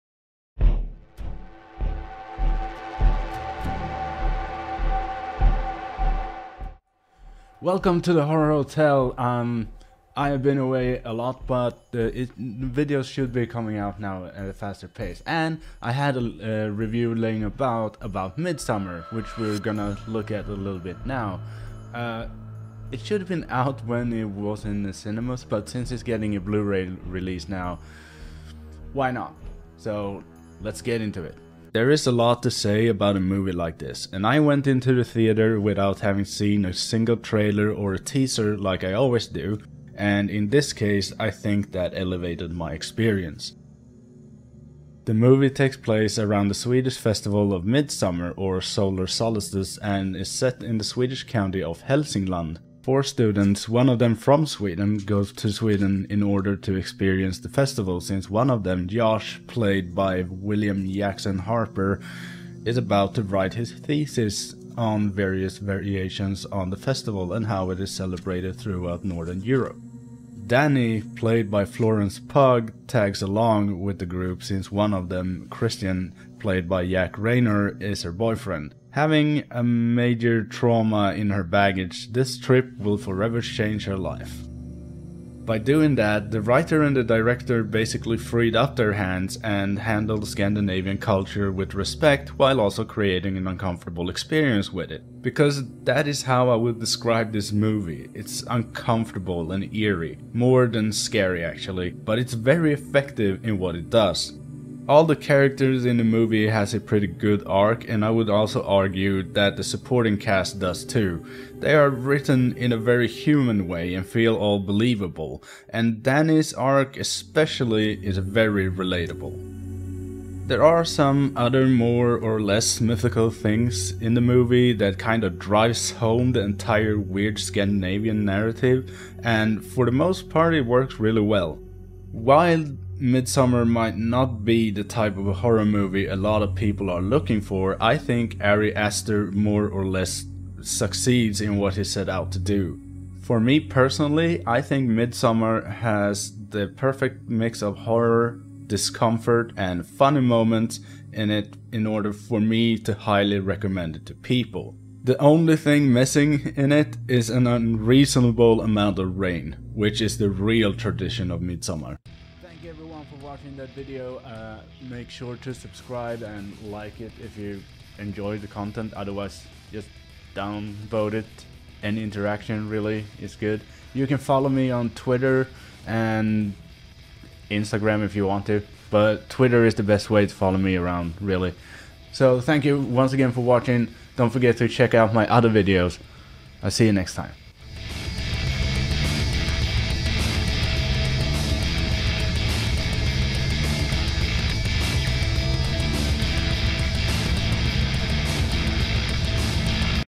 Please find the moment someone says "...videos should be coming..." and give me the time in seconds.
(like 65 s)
12 s.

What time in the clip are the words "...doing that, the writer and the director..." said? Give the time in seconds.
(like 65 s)
85 s.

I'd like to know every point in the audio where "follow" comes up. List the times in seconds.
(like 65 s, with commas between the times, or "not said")
174 s, 180 s.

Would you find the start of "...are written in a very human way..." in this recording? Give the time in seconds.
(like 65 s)
111 s.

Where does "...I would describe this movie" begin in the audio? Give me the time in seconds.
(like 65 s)
96 s.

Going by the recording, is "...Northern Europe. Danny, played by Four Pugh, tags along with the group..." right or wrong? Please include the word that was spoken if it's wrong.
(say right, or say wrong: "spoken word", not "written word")
wrong: "Florence", not "Four".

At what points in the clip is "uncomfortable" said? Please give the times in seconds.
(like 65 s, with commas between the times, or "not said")
93 s, 98 s.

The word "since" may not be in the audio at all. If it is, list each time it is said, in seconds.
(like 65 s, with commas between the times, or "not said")
25 s, 58 s, 74 s.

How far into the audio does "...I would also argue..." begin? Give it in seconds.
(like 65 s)
108 s.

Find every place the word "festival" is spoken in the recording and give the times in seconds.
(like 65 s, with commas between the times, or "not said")
46 s, 57 s, 66 s.